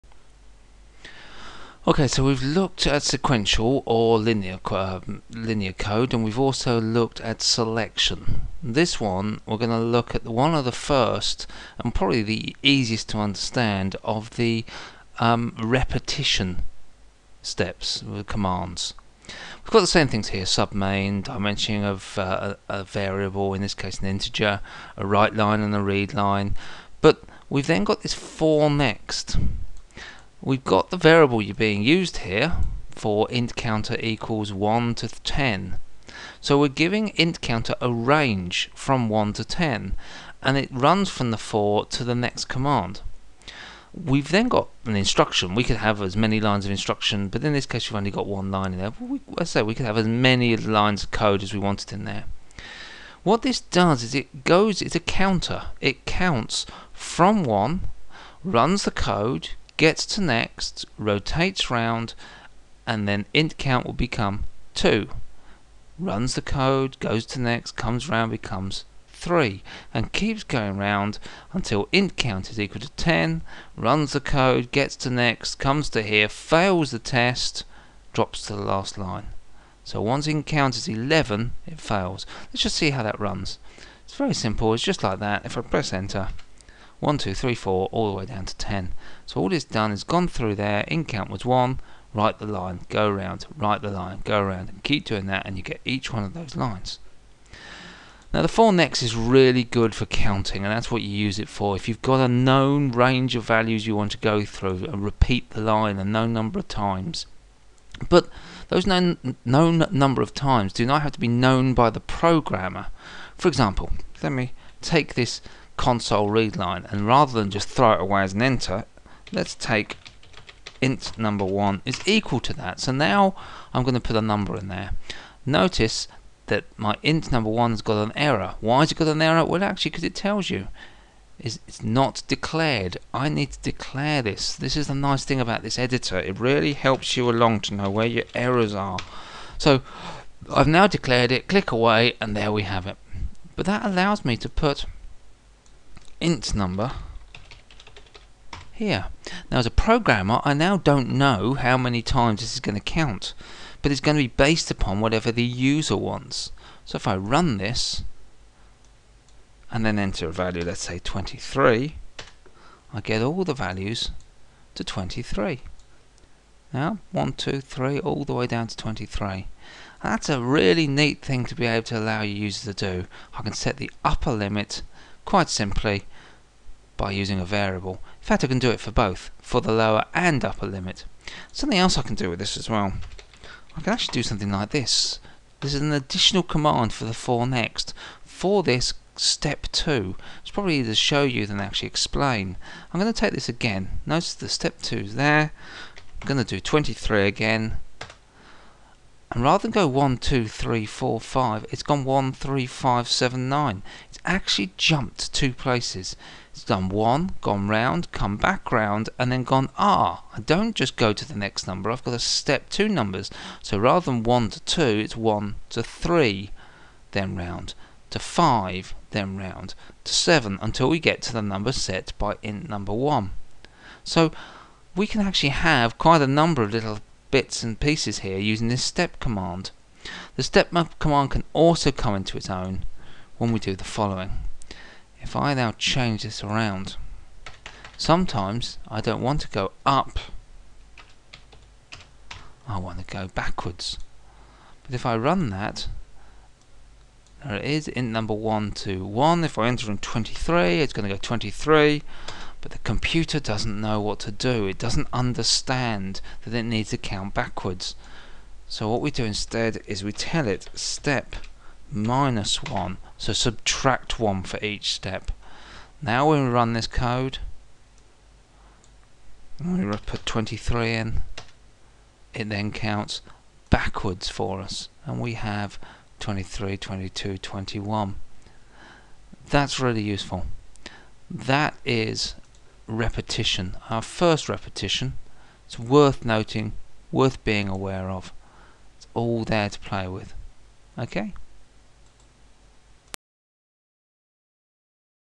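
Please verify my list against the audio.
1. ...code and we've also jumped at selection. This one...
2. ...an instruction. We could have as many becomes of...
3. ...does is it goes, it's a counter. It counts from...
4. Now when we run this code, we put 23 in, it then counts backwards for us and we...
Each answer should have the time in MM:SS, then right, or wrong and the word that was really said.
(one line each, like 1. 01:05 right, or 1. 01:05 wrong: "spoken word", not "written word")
1. 00:05 wrong: "looked", not "jumped"
2. 00:44 wrong: "lines", not "becomes"
3. 00:53 right
4. 04:26 right.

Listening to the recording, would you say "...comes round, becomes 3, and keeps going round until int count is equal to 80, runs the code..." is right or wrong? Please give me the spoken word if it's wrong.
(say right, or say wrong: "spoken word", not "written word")
wrong: "10", not "80".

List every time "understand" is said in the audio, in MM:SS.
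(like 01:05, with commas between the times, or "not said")
00:13, 04:15.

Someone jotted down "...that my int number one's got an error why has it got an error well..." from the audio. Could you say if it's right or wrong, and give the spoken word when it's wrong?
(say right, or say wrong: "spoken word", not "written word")
right.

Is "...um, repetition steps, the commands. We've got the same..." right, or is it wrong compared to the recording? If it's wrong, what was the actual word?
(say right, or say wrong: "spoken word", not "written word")
right.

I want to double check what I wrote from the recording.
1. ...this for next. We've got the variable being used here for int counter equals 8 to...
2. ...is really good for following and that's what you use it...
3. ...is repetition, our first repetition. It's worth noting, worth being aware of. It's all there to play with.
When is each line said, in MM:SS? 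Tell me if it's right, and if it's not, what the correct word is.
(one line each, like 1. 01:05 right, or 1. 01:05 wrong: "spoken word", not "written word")
1. 00:28 wrong: "1", not "8"
2. 01:39 wrong: "counting", not "following"
3. 04:41 right.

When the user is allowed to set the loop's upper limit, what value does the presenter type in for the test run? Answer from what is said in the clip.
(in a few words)
23.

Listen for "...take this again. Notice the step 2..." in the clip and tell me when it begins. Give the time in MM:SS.
03:13.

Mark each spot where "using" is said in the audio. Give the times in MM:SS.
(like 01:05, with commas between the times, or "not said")
02:57, 03:48.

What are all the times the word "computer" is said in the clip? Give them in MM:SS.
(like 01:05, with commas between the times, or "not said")
04:12.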